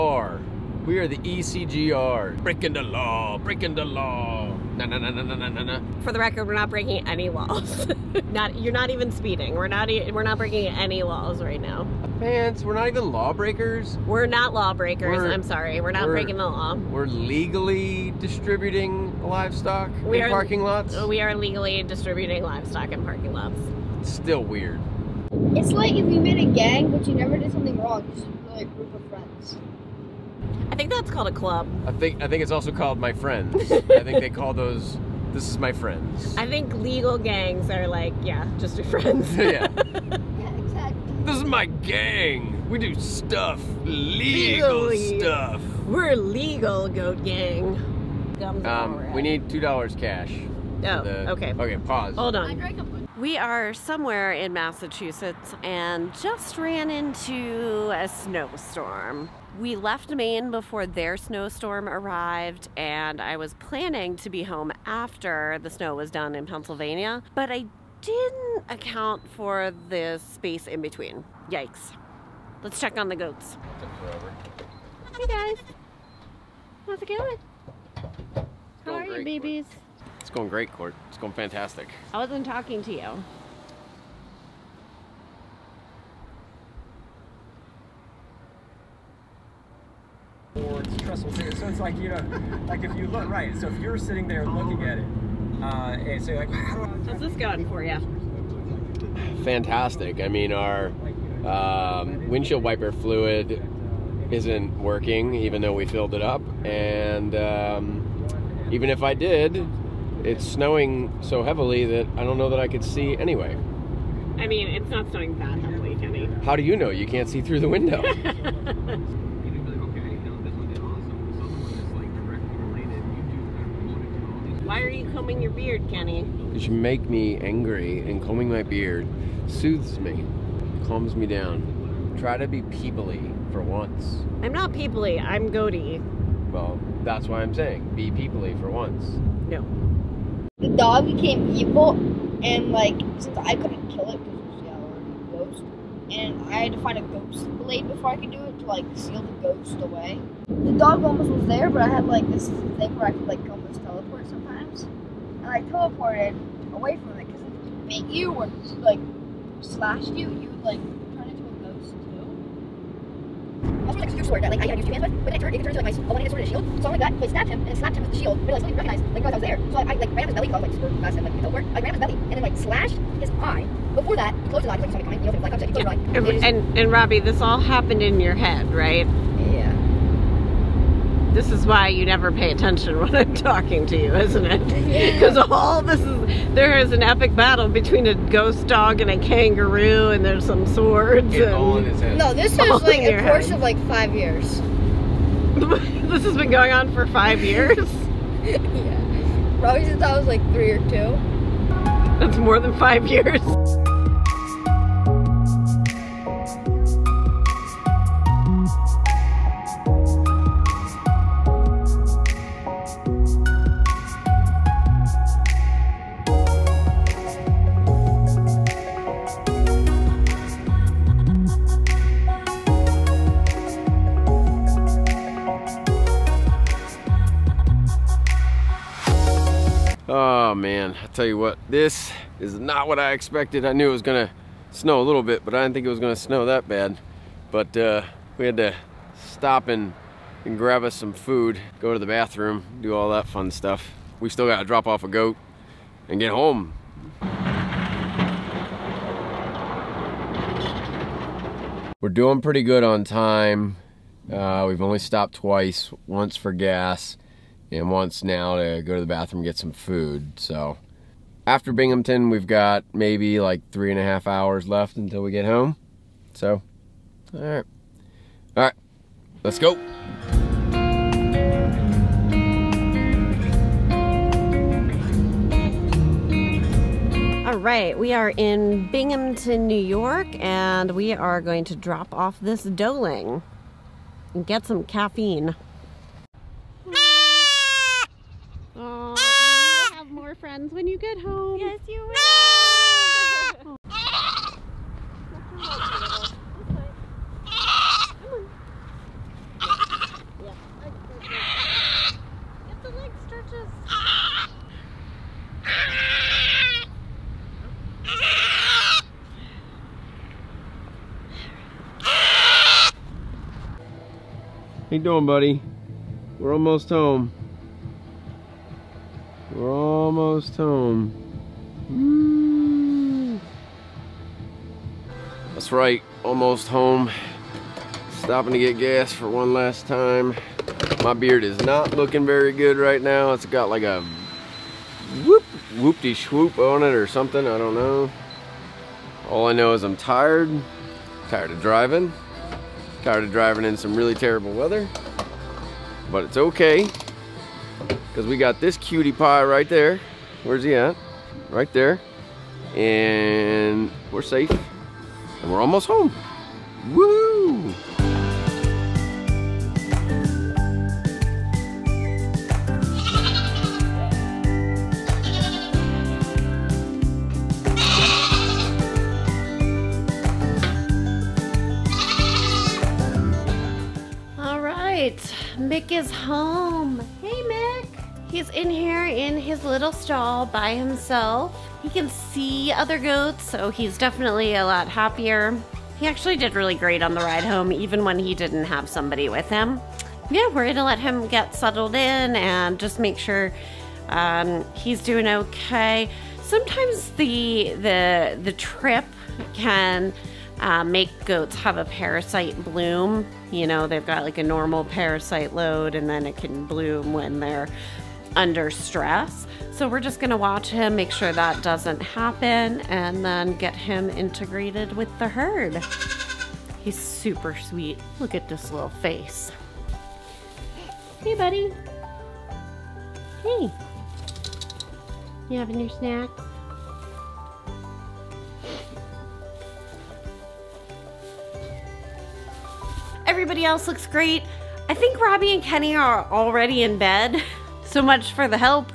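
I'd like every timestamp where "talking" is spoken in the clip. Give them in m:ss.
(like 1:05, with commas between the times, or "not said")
1:22, 3:03.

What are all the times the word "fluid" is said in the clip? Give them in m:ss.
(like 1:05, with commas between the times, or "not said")
1:42.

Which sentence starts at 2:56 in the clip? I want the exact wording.
and, and Robbie, this all happened in your head, right?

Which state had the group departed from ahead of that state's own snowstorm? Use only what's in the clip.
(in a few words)
Maine.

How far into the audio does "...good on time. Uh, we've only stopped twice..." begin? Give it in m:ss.
4:12.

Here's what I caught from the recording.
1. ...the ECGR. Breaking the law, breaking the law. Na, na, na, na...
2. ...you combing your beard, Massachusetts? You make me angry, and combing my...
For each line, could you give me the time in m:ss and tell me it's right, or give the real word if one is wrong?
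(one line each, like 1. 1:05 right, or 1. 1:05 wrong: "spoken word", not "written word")
1. 0:01 right
2. 2:04 wrong: "Kenny", not "Massachusetts".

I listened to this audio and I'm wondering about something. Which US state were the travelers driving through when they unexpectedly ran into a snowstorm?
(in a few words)
Massachusetts.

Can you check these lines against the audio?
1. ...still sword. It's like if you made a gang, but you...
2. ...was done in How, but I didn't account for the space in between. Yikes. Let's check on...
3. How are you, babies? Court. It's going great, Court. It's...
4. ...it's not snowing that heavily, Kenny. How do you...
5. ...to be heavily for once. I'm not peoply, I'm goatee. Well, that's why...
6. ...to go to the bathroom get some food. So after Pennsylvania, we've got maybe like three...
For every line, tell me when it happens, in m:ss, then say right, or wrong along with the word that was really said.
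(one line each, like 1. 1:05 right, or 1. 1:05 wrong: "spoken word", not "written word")
1. 0:24 wrong: "weird", not "sword"
2. 1:05 wrong: "Pennsylvania", not "How"
3. 1:18 right
4. 1:54 right
5. 2:12 wrong: "peoply", not "heavily"
6. 4:18 wrong: "Binghamton", not "Pennsylvania".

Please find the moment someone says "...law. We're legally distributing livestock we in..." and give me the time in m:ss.
0:16.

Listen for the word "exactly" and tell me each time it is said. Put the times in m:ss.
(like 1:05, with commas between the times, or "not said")
0:40.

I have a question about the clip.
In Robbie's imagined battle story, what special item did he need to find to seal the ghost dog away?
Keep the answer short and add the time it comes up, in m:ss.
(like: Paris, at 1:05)
A ghost blade, at 2:27.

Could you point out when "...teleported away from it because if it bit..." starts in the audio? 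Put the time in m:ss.
2:35.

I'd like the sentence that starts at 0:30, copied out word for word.
I think that's called a club.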